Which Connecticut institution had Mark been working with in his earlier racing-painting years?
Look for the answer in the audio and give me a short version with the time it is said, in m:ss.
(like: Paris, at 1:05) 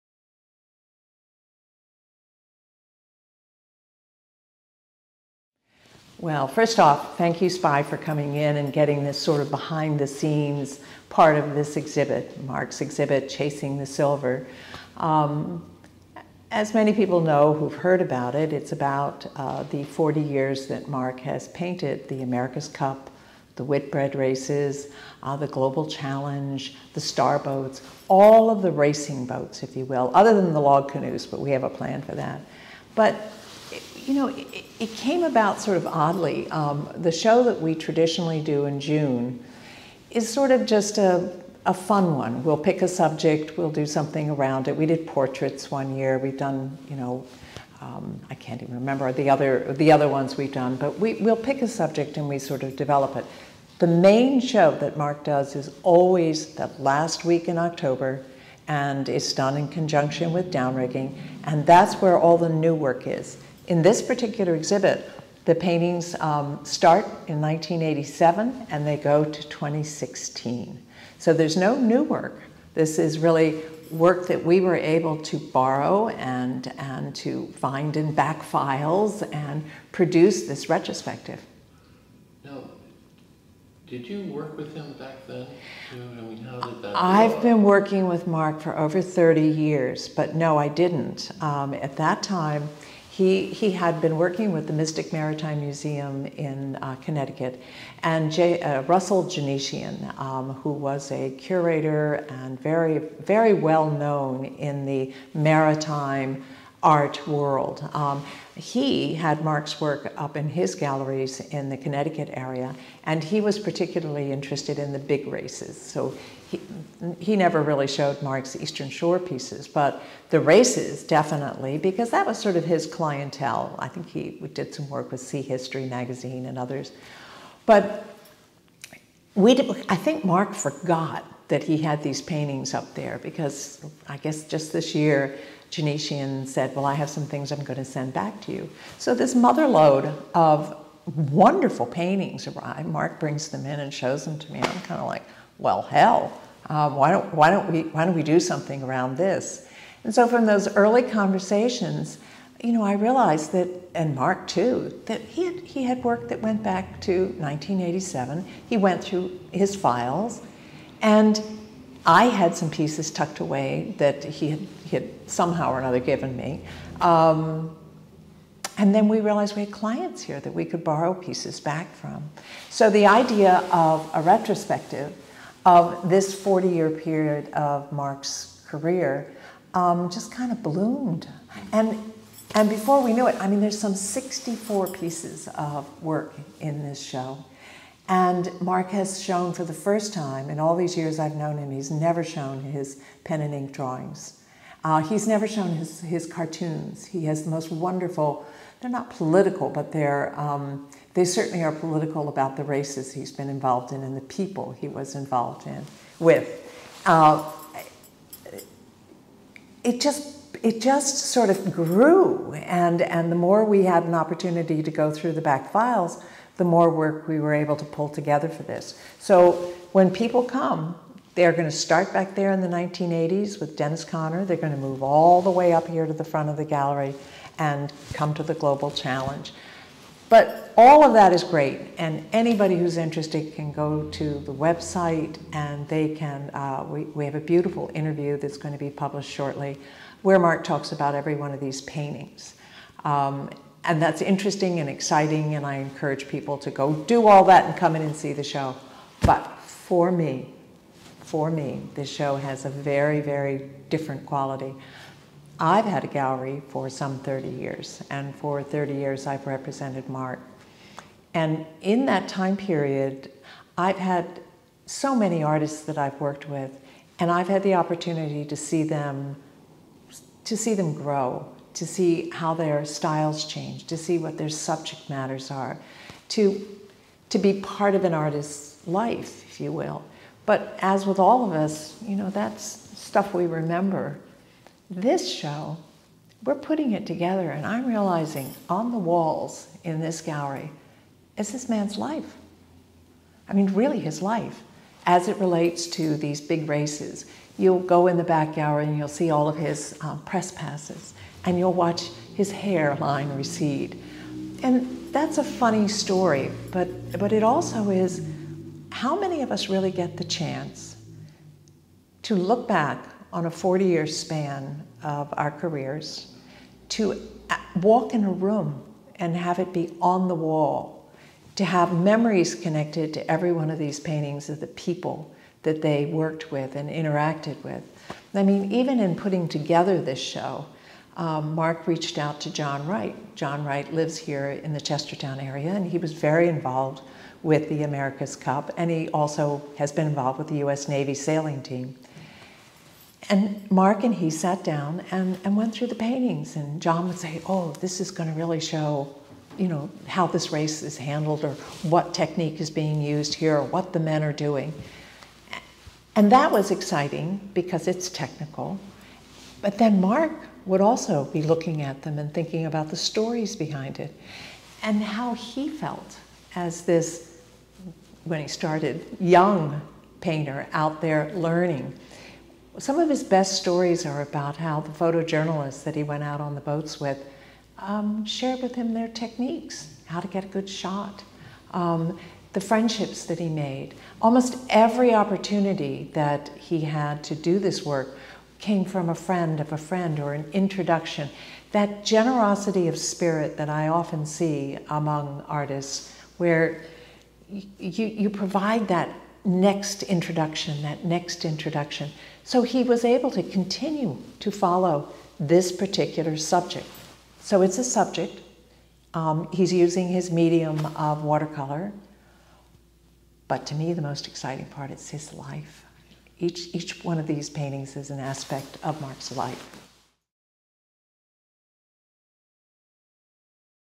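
Mystic Maritime Museum, at 1:34.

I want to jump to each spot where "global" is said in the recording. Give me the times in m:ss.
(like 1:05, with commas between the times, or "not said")
0:25, 3:48.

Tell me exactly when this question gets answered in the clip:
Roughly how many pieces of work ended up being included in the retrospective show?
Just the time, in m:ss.
3:03.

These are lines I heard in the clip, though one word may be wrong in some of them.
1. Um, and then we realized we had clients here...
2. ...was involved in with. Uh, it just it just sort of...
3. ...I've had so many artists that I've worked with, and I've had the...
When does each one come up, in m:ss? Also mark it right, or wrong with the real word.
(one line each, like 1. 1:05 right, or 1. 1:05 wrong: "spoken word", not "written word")
1. 2:46 right
2. 3:24 right
3. 4:23 right.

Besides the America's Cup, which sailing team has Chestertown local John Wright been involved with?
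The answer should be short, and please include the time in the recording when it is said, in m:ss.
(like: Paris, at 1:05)
U.S. Navy sailing team, at 5:40.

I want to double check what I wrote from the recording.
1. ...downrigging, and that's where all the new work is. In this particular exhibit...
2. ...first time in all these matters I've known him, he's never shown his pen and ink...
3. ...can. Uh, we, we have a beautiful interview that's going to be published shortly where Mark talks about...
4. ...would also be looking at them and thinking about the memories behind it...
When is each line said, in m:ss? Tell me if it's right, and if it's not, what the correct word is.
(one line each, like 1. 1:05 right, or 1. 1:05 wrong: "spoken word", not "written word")
1. 1:00 right
2. 3:09 wrong: "years", not "matters"
3. 3:56 right
4. 6:00 wrong: "stories", not "memories".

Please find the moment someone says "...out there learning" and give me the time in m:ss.
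6:10.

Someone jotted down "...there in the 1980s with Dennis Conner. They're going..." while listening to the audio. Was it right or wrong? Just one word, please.
right.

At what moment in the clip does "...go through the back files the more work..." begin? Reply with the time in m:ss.
3:34.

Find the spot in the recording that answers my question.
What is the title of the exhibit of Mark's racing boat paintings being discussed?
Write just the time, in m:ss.
0:13.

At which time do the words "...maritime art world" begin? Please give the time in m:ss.
1:45.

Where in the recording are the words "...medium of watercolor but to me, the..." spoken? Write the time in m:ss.
6:50.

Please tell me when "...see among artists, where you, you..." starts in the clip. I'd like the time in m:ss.
6:34.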